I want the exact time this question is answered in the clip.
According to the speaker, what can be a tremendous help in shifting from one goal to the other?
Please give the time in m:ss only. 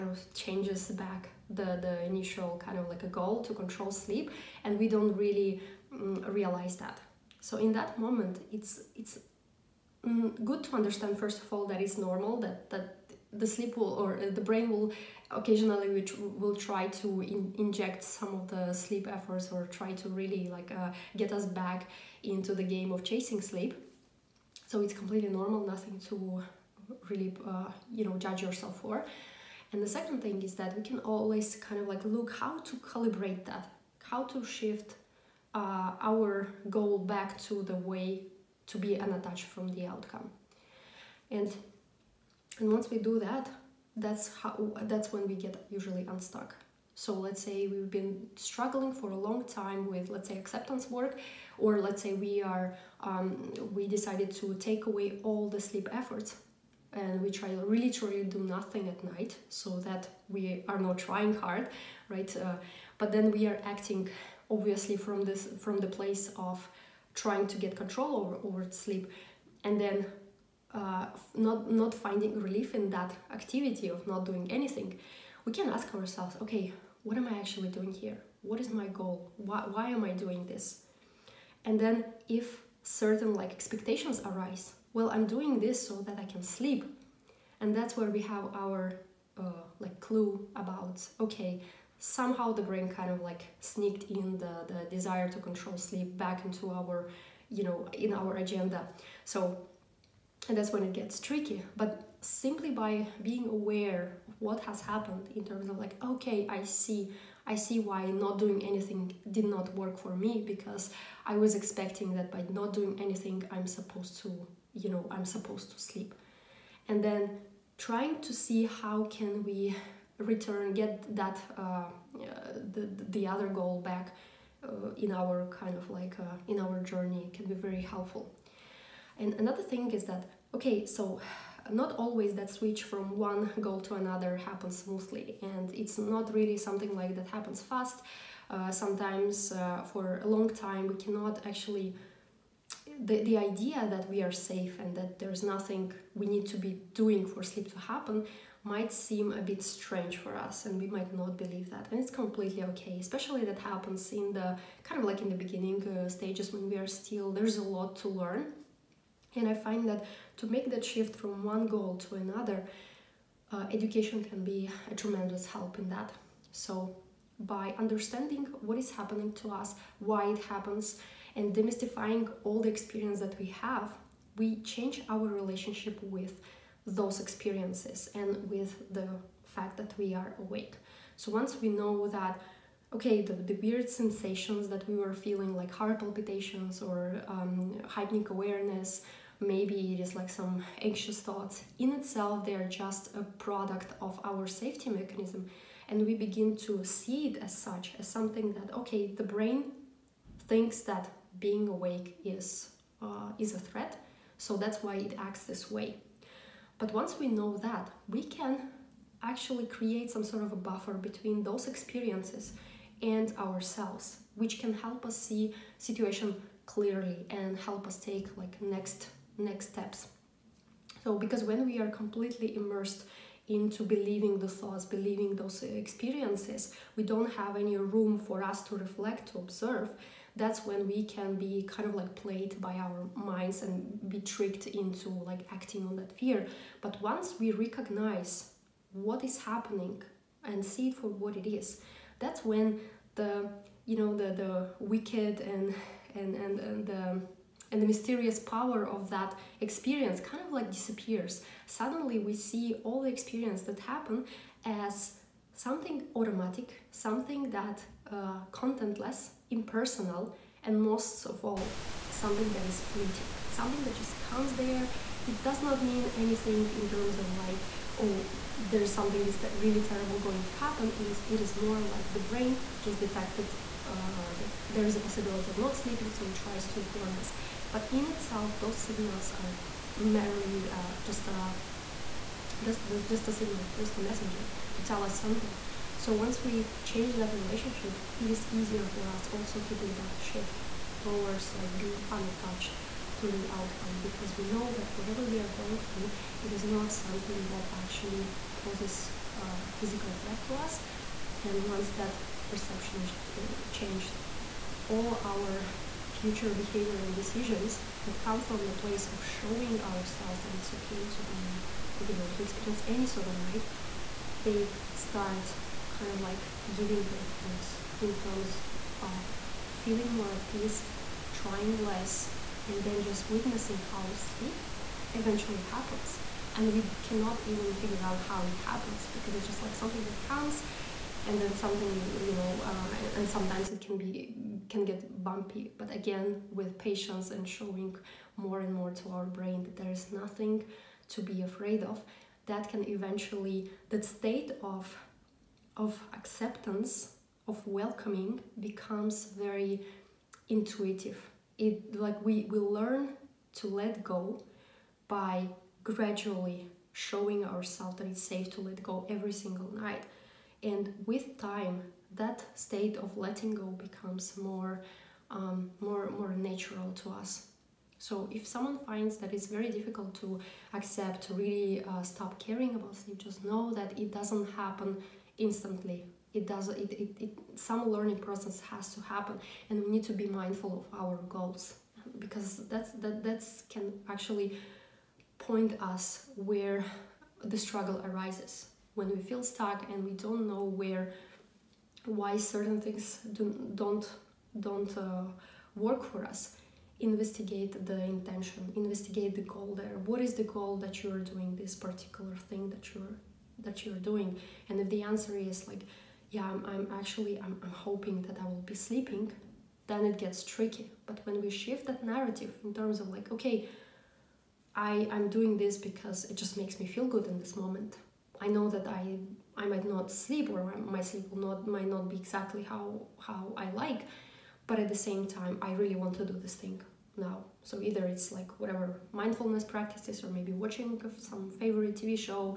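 2:43.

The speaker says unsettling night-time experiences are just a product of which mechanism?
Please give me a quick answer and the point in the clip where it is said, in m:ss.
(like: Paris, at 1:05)
Safety mechanism, at 3:14.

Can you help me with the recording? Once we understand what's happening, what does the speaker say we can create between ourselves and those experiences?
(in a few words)
A buffer.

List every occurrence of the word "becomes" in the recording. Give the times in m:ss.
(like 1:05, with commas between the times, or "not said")
5:48, 6:03.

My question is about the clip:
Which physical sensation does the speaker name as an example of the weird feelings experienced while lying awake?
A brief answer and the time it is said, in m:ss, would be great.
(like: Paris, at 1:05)
Heart palpitations, at 3:05.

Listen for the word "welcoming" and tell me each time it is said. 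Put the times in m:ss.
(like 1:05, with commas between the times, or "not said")
5:47.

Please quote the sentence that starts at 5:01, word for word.
And once that perception uh, changed.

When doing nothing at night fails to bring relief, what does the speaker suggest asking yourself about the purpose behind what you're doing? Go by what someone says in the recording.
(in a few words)
What is my goal?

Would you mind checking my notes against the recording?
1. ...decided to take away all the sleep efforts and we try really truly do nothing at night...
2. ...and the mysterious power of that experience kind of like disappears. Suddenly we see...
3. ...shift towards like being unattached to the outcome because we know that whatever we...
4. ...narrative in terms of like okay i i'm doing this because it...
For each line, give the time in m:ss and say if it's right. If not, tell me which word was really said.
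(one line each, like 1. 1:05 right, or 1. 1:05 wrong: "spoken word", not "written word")
1. 0:53 right
2. 4:07 right
3. 4:50 right
4. 6:52 right.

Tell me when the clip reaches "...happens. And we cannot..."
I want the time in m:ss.
5:25.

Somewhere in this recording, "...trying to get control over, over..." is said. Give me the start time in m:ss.
1:07.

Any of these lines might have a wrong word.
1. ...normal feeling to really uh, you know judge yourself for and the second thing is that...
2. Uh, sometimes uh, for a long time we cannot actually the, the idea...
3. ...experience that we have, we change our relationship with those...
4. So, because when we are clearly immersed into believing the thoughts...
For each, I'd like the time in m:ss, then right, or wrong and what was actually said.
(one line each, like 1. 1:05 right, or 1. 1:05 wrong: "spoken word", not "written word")
1. 0:25 wrong: "nothing", not "feeling"
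2. 2:18 right
3. 2:52 right
4. 3:41 wrong: "completely", not "clearly".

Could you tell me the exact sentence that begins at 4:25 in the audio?
It does not mean anything in terms of like, oh, there's something is really terrible going to happen.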